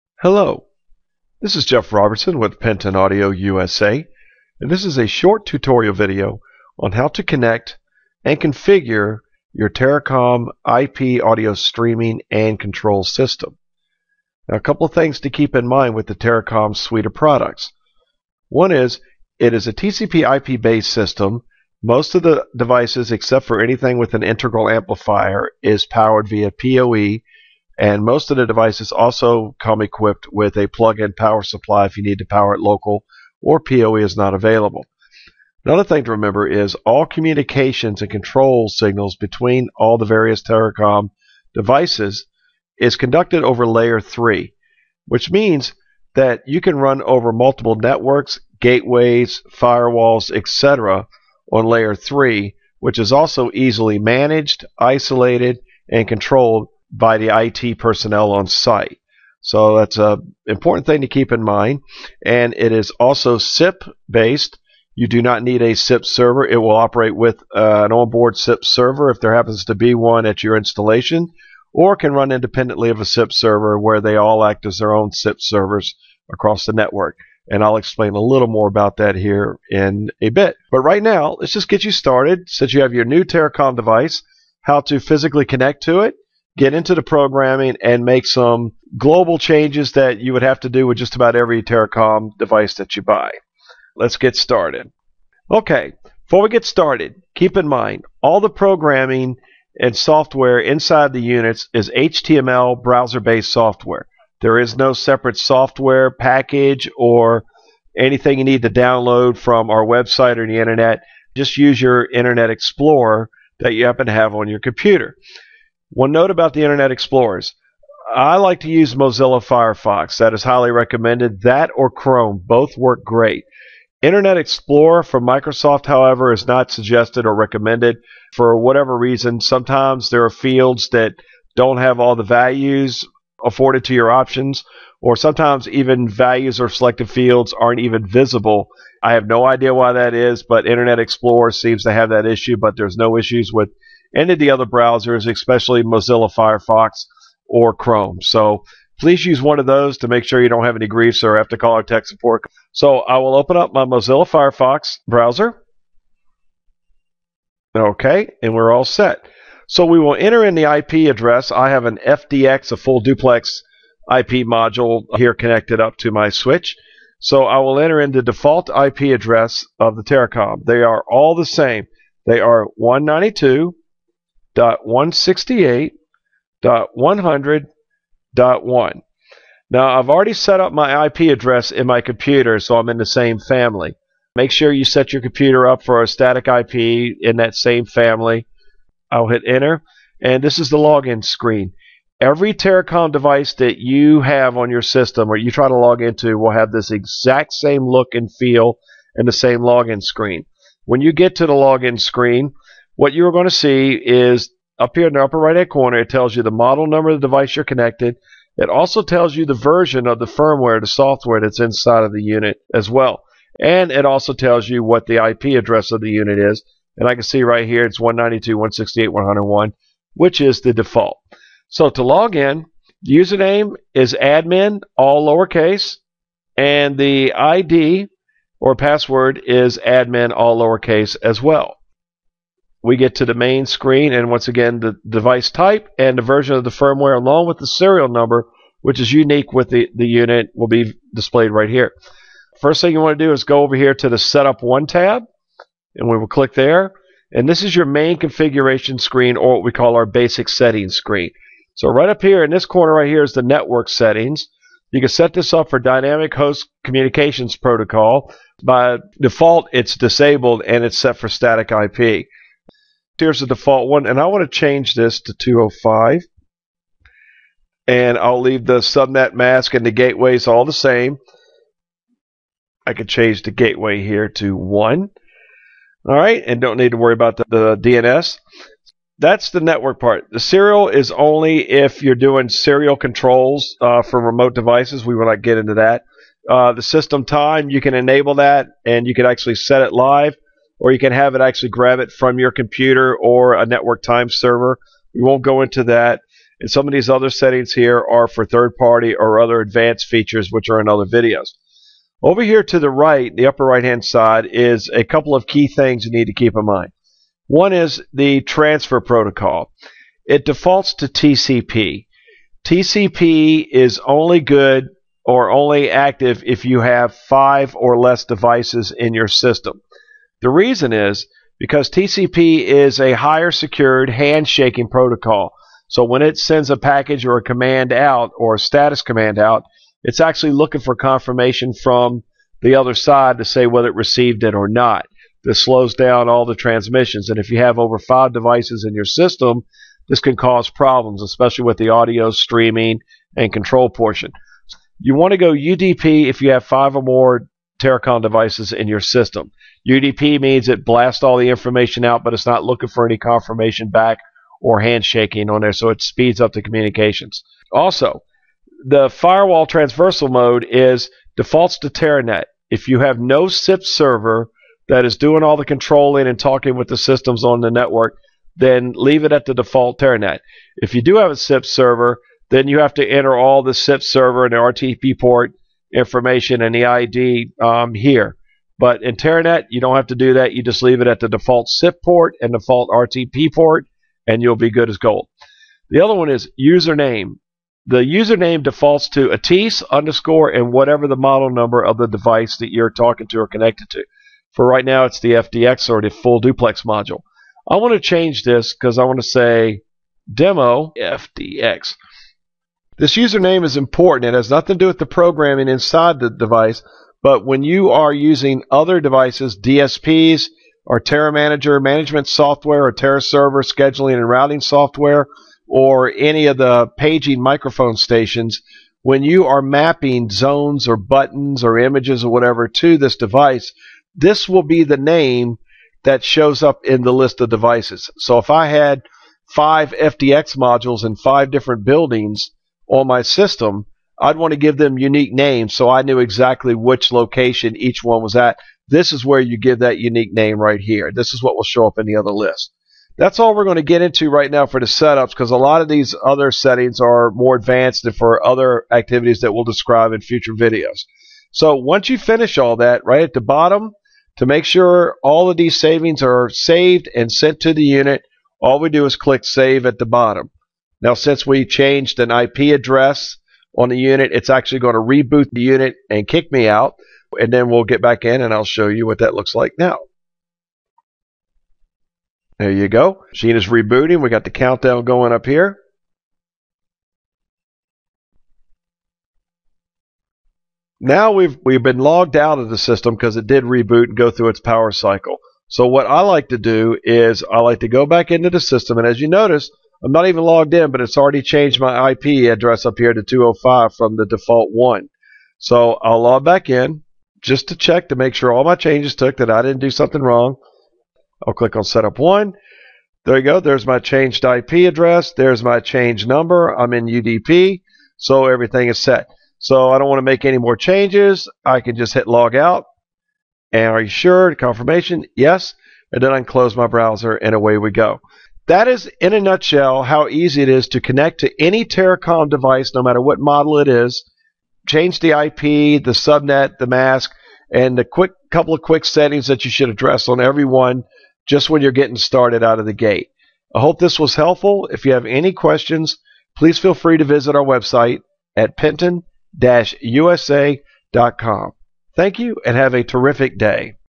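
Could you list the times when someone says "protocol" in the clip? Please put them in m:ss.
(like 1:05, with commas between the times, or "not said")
4:17, 5:09, 5:24.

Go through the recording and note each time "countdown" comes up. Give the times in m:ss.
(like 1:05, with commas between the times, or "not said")
7:54.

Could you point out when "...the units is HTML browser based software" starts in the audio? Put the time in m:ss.
1:41.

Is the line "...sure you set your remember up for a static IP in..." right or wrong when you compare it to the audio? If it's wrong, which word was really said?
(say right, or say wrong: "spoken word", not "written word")
wrong: "computer", not "remember".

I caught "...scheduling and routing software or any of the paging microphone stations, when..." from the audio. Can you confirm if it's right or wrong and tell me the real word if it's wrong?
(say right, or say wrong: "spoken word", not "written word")
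right.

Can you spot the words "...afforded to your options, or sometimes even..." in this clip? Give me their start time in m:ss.
2:13.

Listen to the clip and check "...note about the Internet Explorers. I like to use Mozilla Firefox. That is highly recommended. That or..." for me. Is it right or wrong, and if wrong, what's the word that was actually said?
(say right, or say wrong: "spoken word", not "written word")
right.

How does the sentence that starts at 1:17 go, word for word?
And I'll explain a little more about that here in a bit.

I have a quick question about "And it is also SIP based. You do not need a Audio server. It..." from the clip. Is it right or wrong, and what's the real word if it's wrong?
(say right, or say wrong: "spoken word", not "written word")
wrong: "SIP", not "Audio".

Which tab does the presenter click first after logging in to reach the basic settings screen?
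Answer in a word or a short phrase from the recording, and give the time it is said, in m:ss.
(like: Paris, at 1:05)
Setup 1, at 4:04.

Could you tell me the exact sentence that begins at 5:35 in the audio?
This slows down all the transmissions.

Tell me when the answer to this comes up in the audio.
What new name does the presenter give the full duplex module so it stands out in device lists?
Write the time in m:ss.
6:40.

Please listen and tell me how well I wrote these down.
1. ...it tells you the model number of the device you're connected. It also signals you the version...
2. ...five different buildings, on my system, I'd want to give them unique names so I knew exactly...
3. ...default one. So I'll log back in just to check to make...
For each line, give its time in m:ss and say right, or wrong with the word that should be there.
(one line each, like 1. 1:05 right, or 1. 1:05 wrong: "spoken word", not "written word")
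1. 3:25 wrong: "tells", not "signals"
2. 7:11 right
3. 8:14 right.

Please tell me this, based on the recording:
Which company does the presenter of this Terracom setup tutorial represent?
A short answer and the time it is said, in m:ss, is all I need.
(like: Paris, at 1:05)
Penton Audio USA, at 0:02.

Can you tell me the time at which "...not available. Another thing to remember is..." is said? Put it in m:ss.
0:34.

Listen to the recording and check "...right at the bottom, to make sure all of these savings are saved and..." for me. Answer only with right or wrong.
right.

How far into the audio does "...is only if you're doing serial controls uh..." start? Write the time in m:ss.
4:40.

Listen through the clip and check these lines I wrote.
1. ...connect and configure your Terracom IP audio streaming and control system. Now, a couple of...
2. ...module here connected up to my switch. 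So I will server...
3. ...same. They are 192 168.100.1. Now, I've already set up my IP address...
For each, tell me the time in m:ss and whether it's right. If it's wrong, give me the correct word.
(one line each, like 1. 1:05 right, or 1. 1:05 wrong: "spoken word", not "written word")
1. 0:07 right
2. 2:44 wrong: "enter", not "server"
3. 2:51 right.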